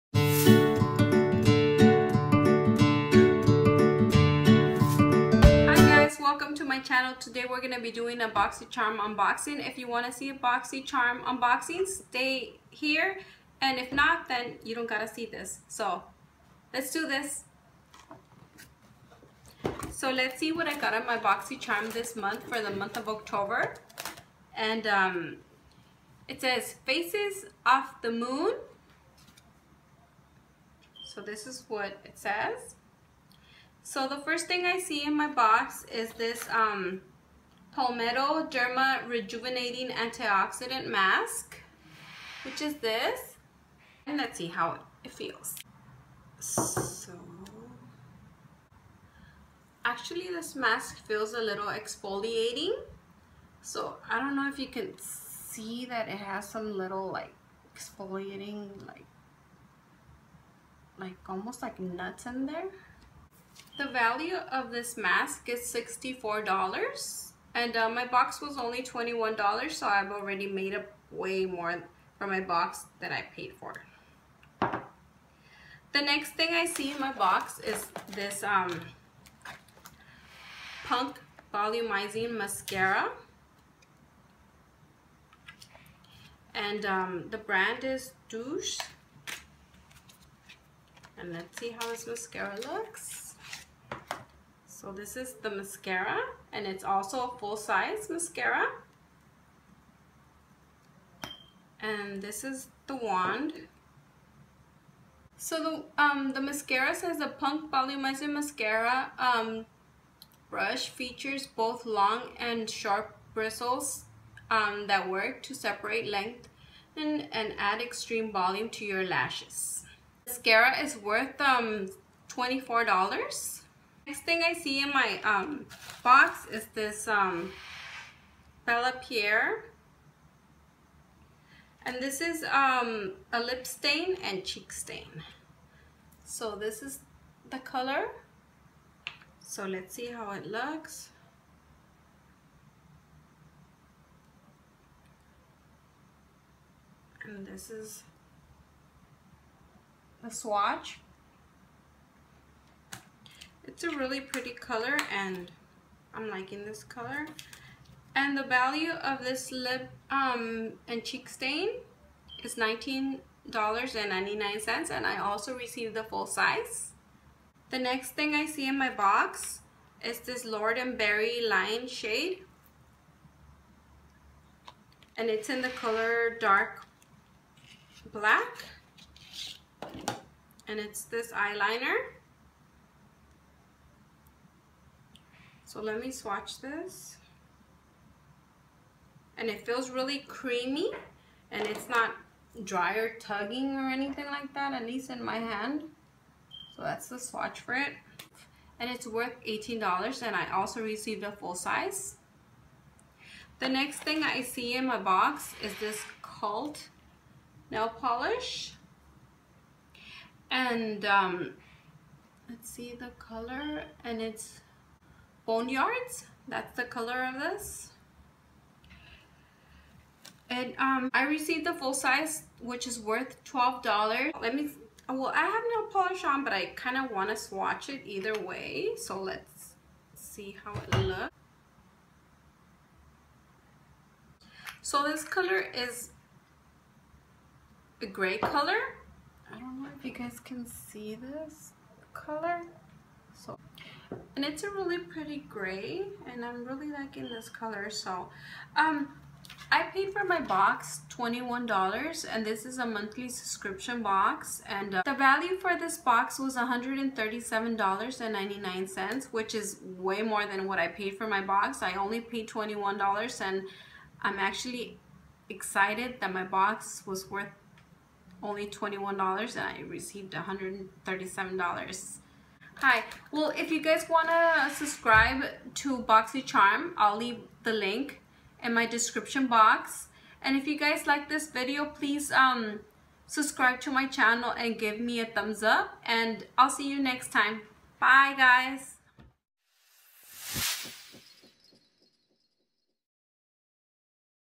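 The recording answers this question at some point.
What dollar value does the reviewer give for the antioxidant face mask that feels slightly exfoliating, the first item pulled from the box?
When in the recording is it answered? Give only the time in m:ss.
1:05.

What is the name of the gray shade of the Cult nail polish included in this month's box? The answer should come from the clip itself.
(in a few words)
Boneyards.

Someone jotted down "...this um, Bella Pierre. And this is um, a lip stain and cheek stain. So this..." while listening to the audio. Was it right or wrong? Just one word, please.
right.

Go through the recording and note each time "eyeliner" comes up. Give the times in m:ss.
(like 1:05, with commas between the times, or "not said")
3:01.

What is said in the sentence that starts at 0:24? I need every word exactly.
And um, it says Faces Off the Moon.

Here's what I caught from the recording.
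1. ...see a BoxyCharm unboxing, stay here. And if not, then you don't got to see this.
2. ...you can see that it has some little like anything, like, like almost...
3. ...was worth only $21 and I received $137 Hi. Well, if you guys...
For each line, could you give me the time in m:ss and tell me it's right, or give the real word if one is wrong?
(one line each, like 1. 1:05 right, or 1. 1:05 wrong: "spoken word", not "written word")
1. 0:10 right
2. 0:54 wrong: "exfoliating", not "anything"
3. 4:27 right.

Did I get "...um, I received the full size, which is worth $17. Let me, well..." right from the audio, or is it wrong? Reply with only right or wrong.
wrong.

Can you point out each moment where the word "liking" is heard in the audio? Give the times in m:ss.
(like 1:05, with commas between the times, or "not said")
2:36, 4:06.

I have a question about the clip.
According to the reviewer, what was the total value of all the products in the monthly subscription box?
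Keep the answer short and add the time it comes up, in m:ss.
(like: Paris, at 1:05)
$137.99, at 4:16.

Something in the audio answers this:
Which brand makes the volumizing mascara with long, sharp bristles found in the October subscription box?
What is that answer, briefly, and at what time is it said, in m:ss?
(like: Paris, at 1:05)
Doucce, at 1:28.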